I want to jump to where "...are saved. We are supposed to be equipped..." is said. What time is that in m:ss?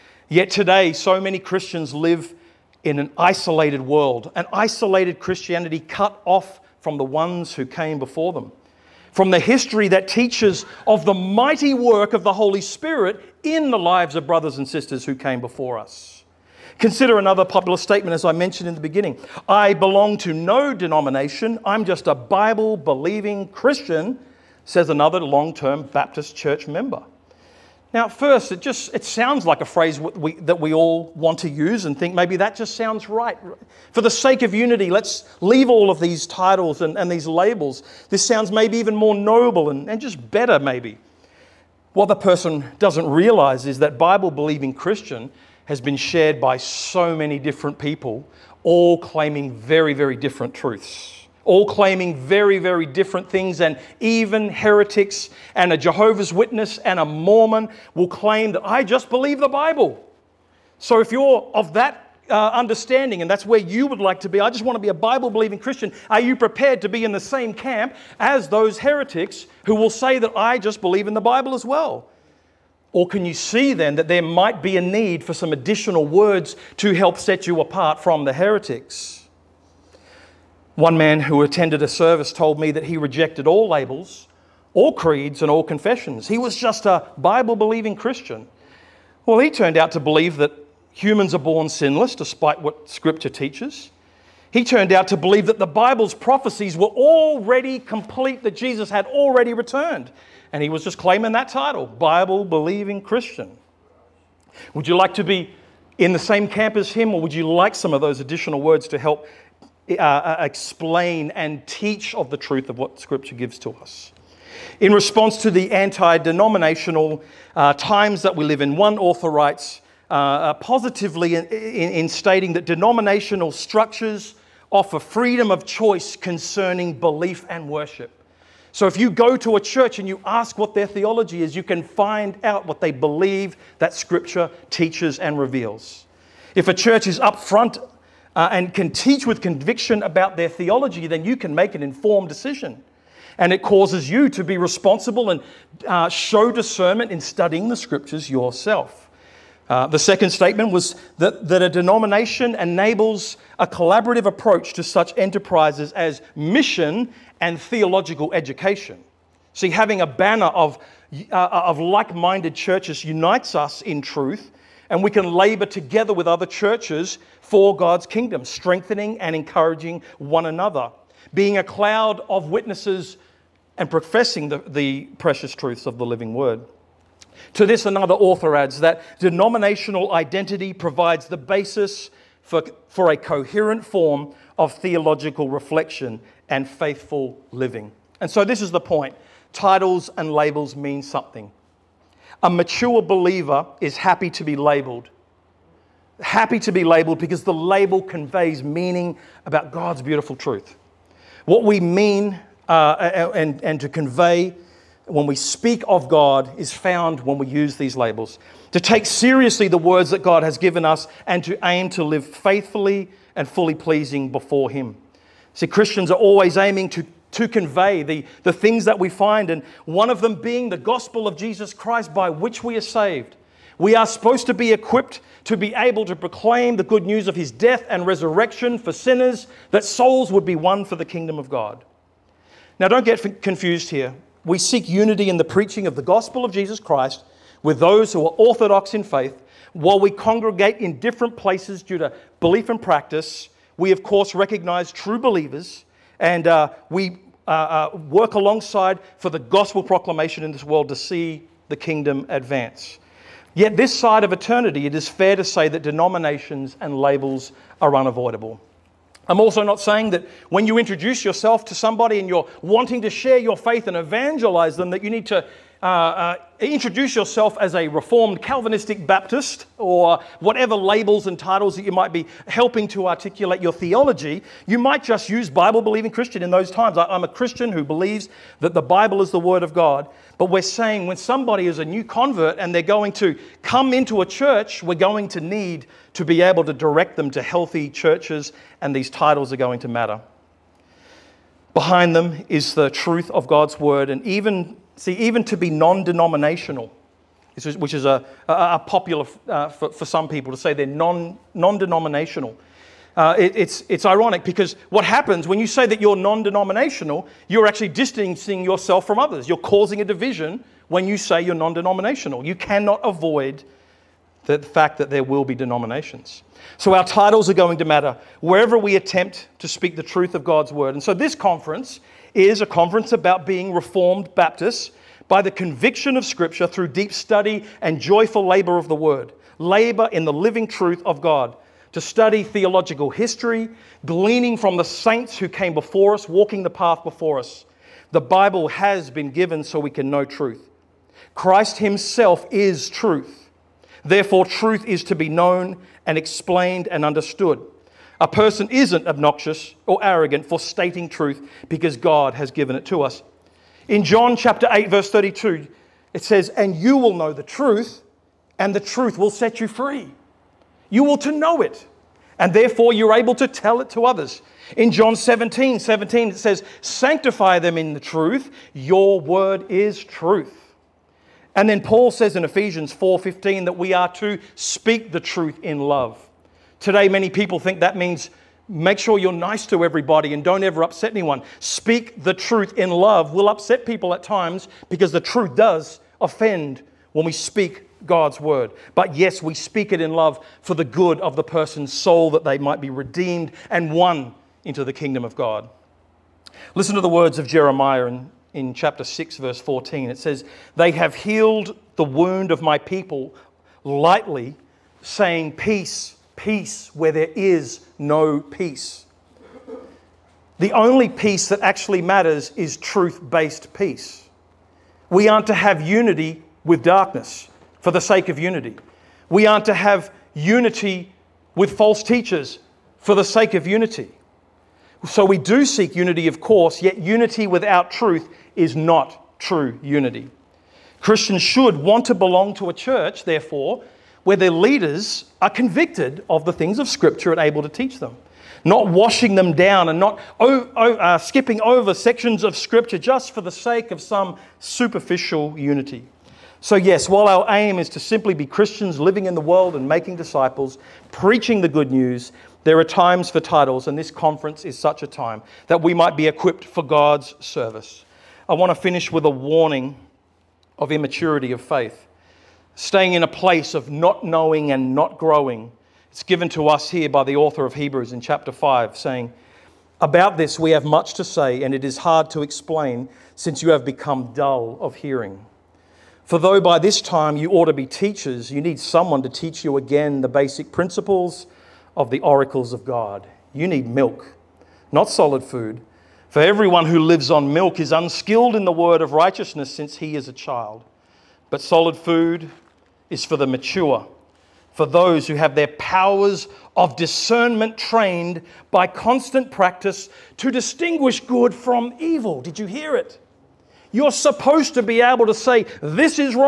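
3:42.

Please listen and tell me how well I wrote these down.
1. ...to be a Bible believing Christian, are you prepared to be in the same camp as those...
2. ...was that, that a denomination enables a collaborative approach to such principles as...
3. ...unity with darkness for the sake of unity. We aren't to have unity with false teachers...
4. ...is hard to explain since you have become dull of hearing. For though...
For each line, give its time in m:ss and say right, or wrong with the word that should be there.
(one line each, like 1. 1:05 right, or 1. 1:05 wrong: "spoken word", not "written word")
1. 1:04 right
2. 2:30 wrong: "enterprises", not "principles"
3. 6:55 right
4. 7:51 right.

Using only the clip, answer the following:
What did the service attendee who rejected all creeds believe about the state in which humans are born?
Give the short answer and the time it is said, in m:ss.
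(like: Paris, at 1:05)
Sinless, at 1:31.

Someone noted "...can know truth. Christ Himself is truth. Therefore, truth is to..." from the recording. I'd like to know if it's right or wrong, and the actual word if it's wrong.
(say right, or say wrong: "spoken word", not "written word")
right.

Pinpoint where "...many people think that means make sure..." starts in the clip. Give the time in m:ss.
6:17.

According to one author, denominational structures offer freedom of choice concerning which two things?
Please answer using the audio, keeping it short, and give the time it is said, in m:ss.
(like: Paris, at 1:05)
Belief and worship, at 2:06.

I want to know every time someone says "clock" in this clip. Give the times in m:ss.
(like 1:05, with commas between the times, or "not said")
not said.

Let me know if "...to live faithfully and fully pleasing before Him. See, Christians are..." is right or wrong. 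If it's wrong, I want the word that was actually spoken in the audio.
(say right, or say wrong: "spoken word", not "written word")
right.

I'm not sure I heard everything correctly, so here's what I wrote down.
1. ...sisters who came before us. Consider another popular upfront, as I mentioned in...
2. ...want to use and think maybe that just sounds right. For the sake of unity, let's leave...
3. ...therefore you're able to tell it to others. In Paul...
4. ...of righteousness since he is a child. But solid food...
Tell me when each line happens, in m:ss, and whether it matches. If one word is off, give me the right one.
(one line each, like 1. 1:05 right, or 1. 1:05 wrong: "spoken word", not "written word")
1. 0:14 wrong: "statement", not "upfront"
2. 0:31 right
3. 6:02 wrong: "John", not "Paul"
4. 8:09 right.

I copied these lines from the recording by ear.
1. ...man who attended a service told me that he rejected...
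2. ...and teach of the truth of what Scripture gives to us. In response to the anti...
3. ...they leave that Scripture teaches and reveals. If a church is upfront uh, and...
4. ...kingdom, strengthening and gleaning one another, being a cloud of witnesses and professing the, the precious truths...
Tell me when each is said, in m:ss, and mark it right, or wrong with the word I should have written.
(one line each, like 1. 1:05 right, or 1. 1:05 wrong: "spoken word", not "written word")
1. 1:20 right
2. 1:51 right
3. 2:12 wrong: "believe", not "leave"
4. 2:48 wrong: "encouraging", not "gleaning".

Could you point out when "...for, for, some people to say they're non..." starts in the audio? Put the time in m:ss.
4:59.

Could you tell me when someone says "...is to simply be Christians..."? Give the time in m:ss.
7:27.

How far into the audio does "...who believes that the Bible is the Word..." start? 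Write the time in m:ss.
4:37.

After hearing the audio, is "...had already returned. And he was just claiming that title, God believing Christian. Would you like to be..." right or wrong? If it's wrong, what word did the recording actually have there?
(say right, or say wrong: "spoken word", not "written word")
wrong: "Bible", not "God".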